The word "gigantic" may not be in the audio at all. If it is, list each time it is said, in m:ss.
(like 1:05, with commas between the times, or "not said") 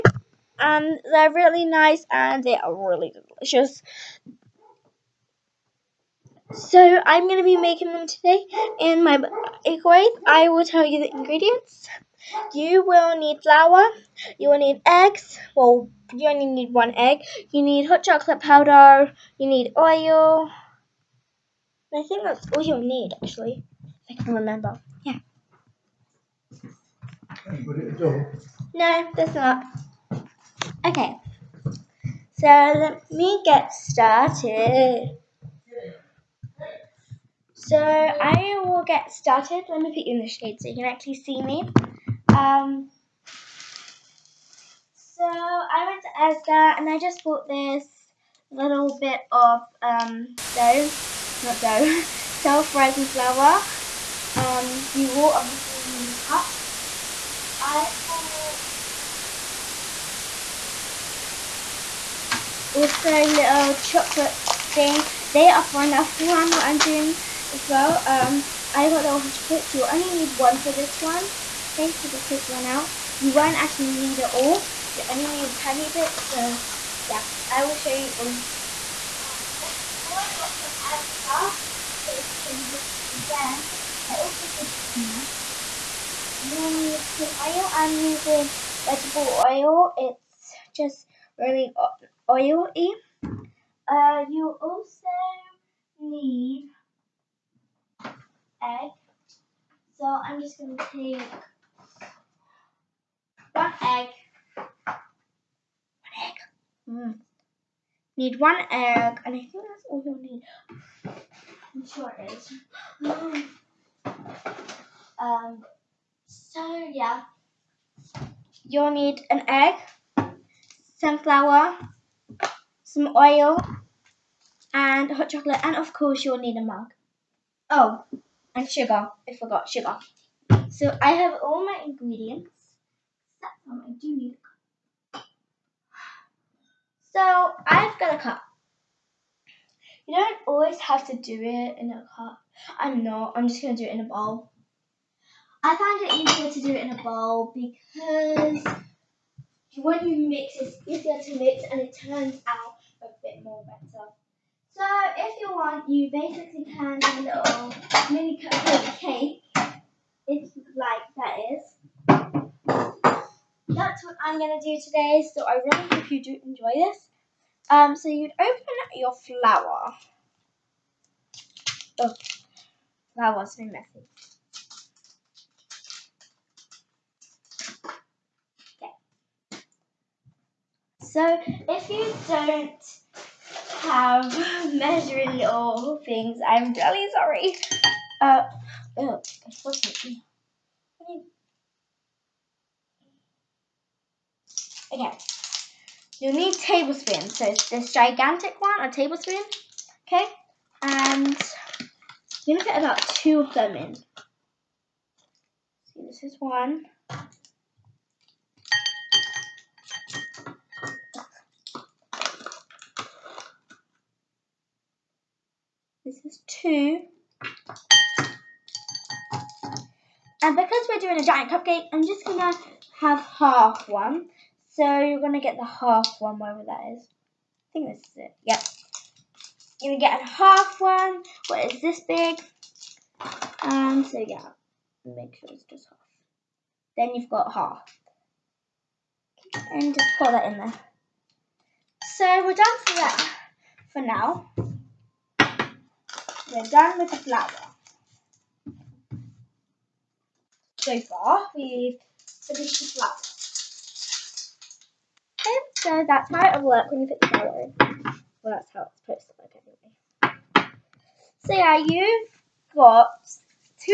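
3:17.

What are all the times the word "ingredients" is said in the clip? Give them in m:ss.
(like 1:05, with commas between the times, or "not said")
0:11, 2:11.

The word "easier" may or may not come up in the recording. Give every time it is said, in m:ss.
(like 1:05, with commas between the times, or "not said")
2:26, 2:30.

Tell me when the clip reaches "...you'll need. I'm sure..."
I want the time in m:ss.
1:50.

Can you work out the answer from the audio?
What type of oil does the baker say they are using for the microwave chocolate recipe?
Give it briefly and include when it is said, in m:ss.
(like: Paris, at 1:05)
vegetable oil, at 1:28.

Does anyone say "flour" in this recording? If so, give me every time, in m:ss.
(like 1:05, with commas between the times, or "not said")
0:13, 0:53, 2:01, 2:49, 4:07, 4:12.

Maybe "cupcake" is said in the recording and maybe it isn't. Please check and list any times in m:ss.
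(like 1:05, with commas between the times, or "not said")
2:38, 3:41.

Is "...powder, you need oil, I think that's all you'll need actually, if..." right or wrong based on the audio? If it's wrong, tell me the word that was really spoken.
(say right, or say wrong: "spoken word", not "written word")
right.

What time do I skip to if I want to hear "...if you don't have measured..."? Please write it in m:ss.
3:01.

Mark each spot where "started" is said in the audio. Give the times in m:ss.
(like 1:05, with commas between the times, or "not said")
0:33, 0:39.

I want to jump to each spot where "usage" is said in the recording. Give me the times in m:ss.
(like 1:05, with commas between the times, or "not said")
not said.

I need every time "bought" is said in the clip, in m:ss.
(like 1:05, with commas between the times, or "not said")
0:47, 1:02.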